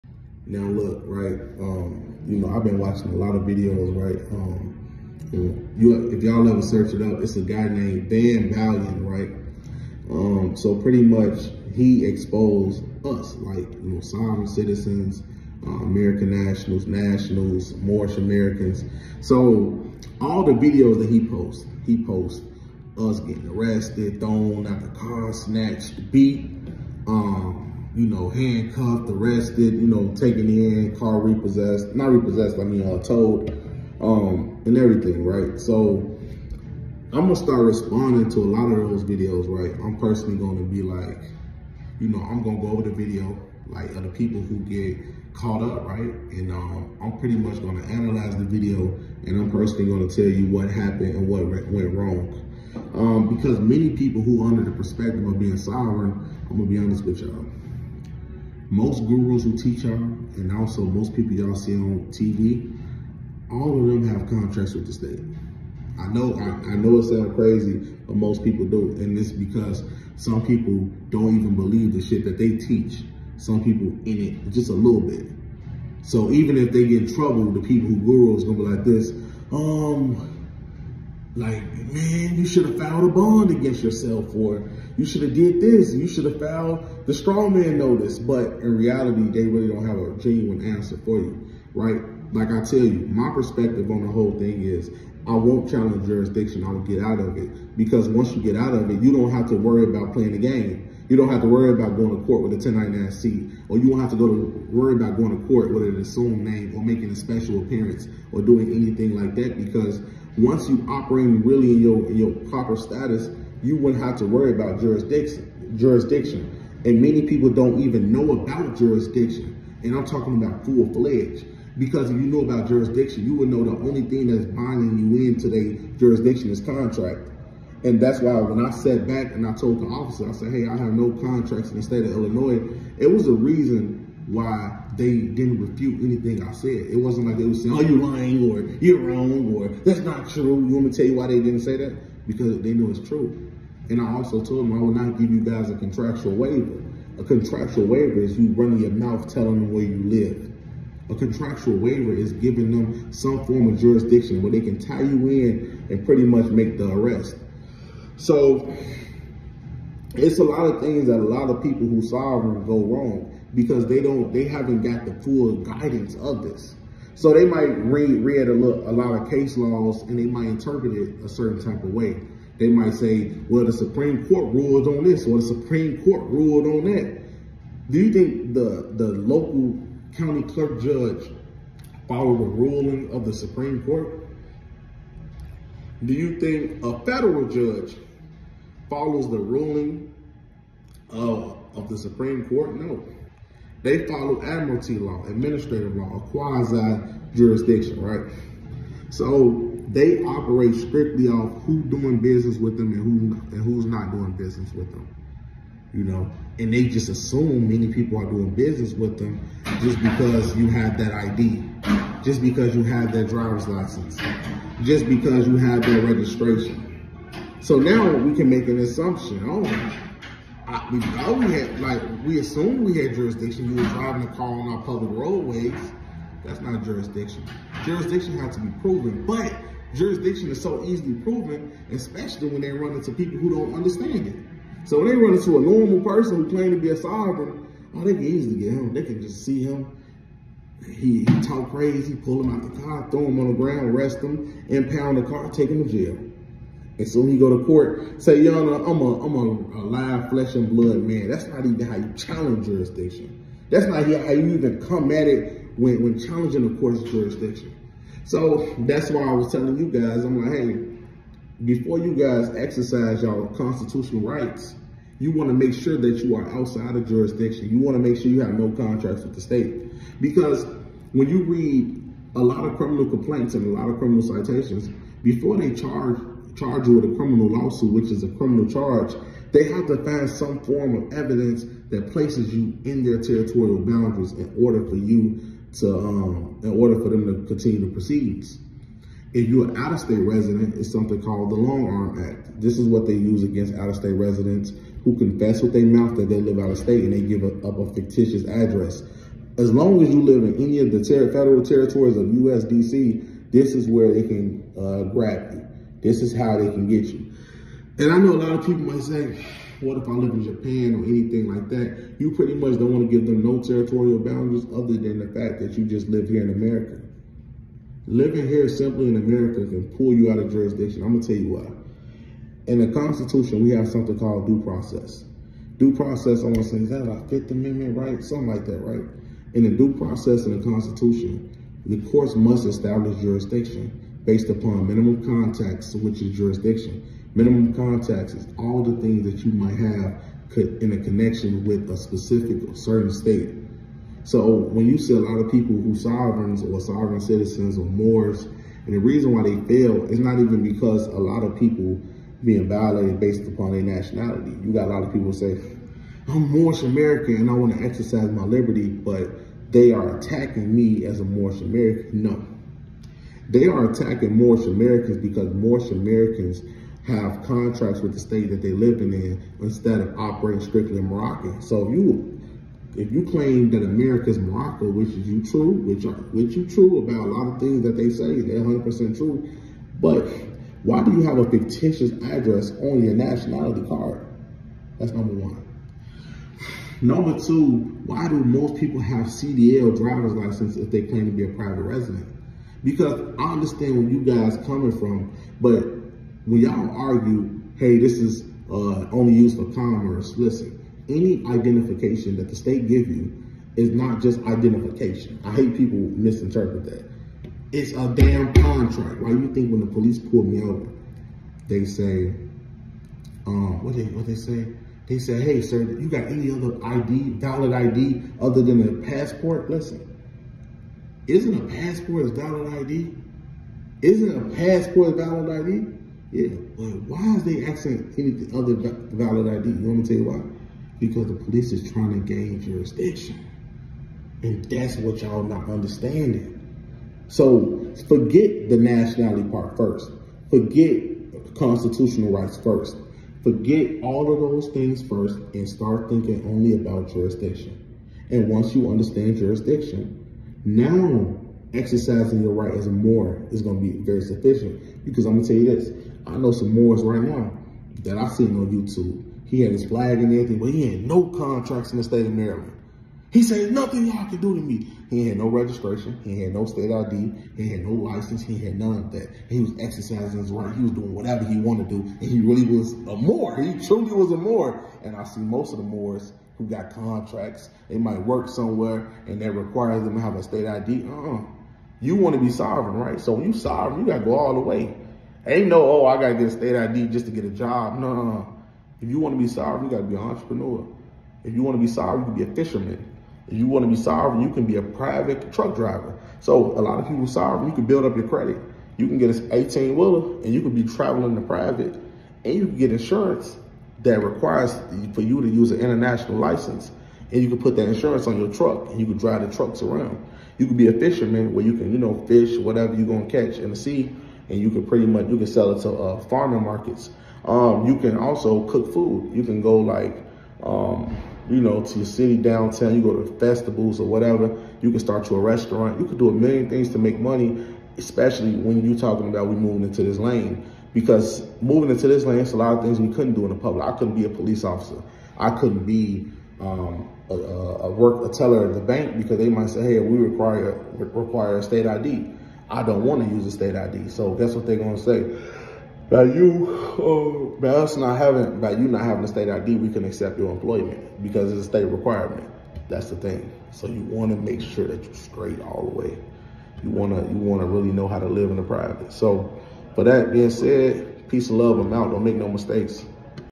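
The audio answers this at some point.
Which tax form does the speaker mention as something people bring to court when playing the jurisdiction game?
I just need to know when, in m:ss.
1:42.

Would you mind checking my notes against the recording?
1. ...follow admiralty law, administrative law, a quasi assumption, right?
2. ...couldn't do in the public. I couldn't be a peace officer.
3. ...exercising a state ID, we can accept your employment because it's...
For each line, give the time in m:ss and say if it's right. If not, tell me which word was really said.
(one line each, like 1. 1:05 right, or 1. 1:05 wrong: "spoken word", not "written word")
1. 3:14 wrong: "jurisdiction", not "assumption"
2. 8:53 wrong: "police", not "peace"
3. 9:09 wrong: "having", not "exercising".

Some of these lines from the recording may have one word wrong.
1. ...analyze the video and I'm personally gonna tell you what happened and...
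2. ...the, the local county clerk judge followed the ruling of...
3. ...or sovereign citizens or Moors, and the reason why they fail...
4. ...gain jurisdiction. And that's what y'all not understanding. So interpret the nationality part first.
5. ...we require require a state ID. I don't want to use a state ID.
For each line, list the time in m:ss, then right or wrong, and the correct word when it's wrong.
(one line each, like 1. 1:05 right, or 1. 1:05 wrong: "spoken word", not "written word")
1. 0:47 right
2. 2:58 right
3. 5:46 right
4. 7:12 wrong: "forget", not "interpret"
5. 8:59 right.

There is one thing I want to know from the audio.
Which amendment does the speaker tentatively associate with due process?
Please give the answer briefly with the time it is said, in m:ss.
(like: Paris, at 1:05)
Fifth Amendment, at 5:27.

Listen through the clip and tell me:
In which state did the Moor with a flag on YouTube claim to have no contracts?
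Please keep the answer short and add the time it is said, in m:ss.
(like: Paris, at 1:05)
Maryland, at 7:42.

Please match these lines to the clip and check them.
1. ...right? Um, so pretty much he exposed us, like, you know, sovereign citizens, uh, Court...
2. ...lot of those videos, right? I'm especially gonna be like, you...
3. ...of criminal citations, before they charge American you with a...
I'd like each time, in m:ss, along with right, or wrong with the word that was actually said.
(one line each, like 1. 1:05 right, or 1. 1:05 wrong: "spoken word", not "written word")
1. 0:09 wrong: "American", not "Court"
2. 0:38 wrong: "personally", not "especially"
3. 4:33 wrong: "Charge", not "American".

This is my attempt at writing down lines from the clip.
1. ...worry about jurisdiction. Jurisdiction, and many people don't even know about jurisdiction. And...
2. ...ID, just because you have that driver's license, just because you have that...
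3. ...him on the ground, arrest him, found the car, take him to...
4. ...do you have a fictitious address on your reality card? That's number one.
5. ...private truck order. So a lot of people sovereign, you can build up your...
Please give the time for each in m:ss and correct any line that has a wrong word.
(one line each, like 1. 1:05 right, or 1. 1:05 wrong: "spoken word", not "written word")
1. 1:54 right
2. 3:31 right
3. 4:03 wrong: "impound", not "found"
4. 6:21 wrong: "nationality", not "reality"
5. 8:14 wrong: "driver", not "order".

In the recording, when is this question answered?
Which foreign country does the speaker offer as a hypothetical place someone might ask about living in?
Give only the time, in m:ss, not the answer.
5:10.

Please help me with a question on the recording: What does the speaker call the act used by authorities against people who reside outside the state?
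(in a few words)
Long Arm Act.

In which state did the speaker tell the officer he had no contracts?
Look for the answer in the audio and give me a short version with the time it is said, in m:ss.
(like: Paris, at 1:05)
Illinois, at 2:12.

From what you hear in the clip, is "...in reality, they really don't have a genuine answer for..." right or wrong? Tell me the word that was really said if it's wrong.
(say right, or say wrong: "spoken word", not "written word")
right.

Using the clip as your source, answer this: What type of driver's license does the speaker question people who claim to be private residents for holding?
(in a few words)
CDL.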